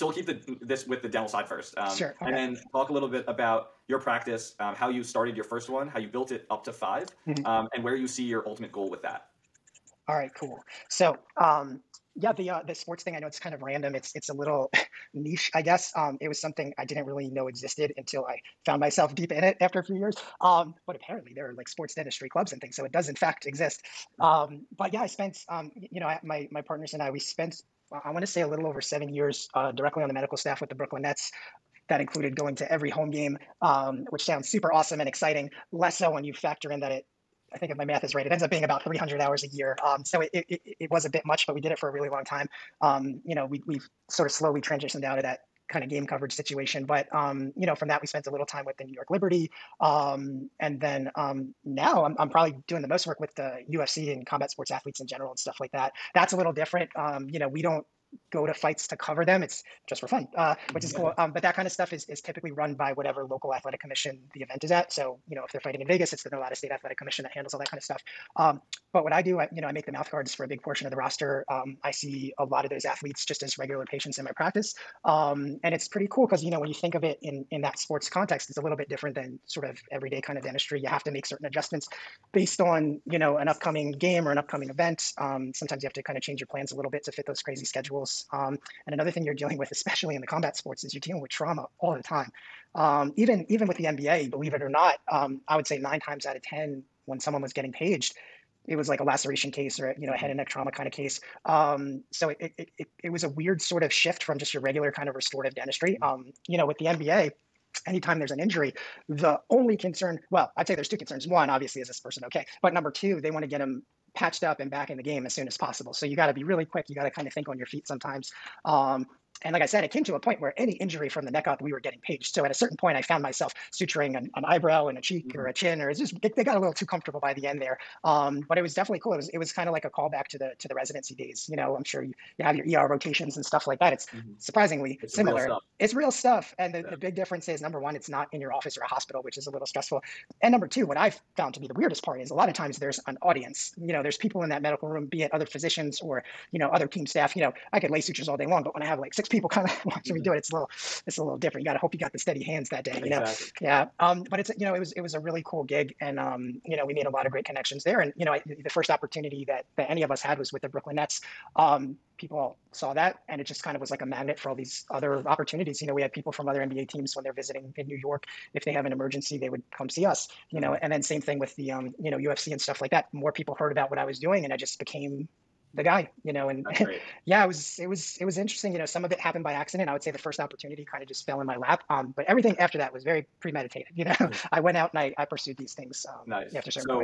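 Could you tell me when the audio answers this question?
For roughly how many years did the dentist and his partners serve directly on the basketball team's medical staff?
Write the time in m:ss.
0:28.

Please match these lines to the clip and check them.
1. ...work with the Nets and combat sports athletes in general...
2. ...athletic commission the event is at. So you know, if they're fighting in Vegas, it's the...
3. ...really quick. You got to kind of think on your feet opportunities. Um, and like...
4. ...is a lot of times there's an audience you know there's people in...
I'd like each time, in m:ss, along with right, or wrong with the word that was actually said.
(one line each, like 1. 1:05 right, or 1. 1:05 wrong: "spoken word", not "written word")
1. 0:53 wrong: "UFC", not "Nets"
2. 1:03 right
3. 1:56 wrong: "sometimes", not "opportunities"
4. 2:22 right.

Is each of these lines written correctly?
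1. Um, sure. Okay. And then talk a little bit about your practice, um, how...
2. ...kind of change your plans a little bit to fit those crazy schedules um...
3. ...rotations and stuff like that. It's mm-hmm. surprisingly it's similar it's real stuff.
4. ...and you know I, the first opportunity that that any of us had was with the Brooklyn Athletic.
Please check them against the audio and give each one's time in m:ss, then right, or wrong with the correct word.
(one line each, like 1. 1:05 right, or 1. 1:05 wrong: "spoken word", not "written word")
1. 0:01 right
2. 1:26 right
3. 2:12 right
4. 2:37 wrong: "Nets", not "Athletic".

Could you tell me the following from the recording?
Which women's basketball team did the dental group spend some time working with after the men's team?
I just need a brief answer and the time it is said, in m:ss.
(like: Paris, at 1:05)
New York Liberty, at 0:48.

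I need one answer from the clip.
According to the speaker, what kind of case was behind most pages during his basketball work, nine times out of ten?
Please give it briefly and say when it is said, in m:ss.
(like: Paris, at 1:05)
Laceration, at 1:39.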